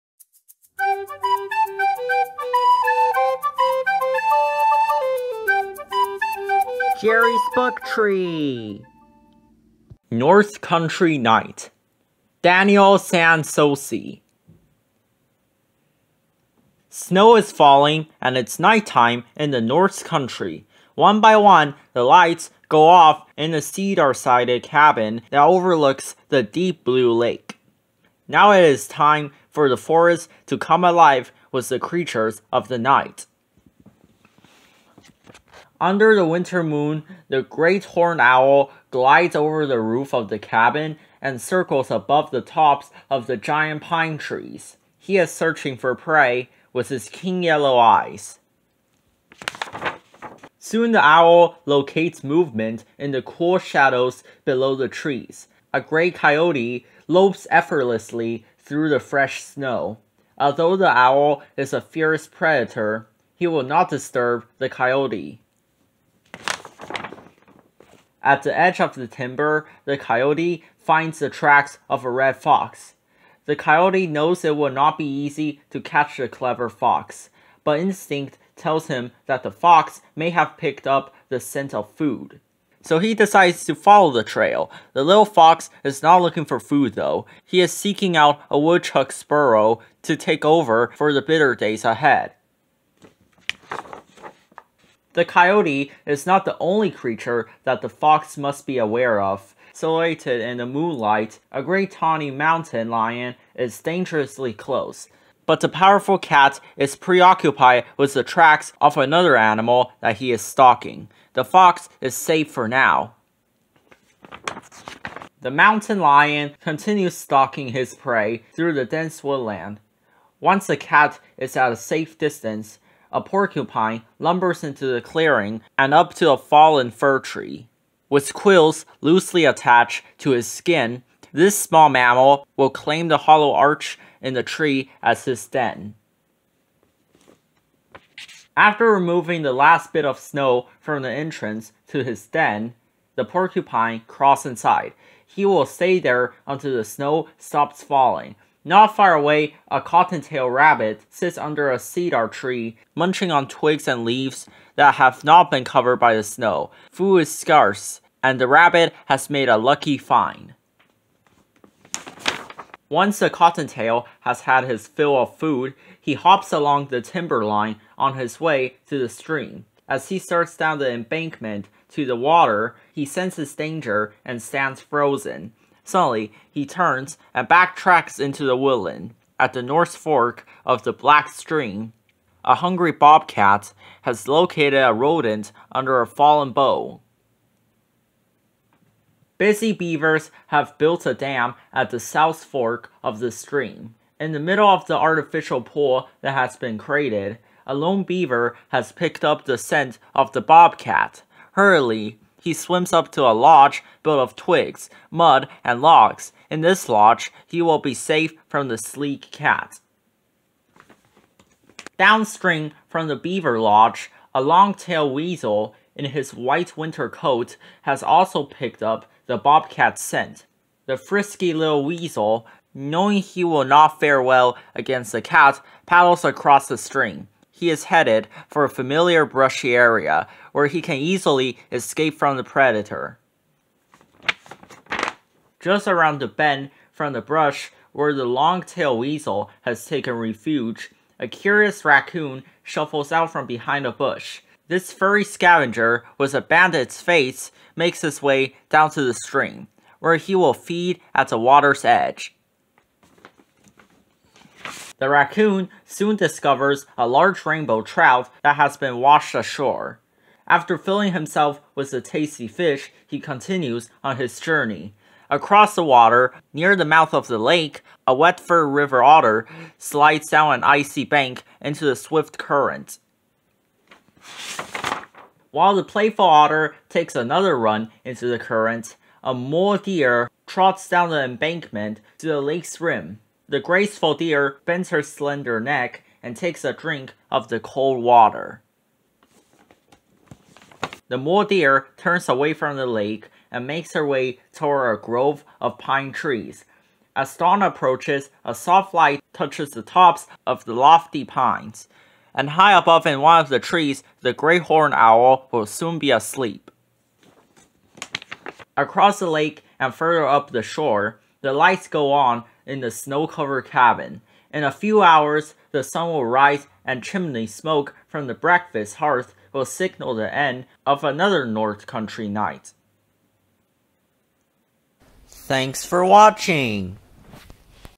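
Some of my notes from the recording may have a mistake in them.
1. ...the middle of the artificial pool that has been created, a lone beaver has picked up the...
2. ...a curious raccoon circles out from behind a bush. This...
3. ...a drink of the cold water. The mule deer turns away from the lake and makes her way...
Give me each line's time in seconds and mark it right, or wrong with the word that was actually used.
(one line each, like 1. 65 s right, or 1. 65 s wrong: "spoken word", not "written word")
1. 194 s right
2. 241 s wrong: "shuffles", not "circles"
3. 286 s right.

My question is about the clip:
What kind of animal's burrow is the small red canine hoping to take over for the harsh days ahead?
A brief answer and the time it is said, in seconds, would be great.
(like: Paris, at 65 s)
Woodchuck, at 88 s.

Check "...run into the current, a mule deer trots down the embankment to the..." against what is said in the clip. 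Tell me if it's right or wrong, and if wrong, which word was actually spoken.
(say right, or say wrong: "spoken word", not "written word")
right.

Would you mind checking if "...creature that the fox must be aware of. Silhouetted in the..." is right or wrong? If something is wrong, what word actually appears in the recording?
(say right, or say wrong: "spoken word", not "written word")
right.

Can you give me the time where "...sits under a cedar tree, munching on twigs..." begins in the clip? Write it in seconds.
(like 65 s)
151 s.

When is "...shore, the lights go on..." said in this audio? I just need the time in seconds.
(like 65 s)
310 s.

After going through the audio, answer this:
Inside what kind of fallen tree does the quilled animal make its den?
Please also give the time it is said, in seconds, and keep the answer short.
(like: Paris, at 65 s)
Fir tree, at 126 s.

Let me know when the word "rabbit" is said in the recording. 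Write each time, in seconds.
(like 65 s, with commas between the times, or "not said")
150 s, 158 s.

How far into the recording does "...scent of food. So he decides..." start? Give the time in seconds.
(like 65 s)
81 s.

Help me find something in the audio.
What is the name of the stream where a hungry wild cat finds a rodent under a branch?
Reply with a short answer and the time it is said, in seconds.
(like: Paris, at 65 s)
Black Stream, at 180 s.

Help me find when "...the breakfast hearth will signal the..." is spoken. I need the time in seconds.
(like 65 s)
318 s.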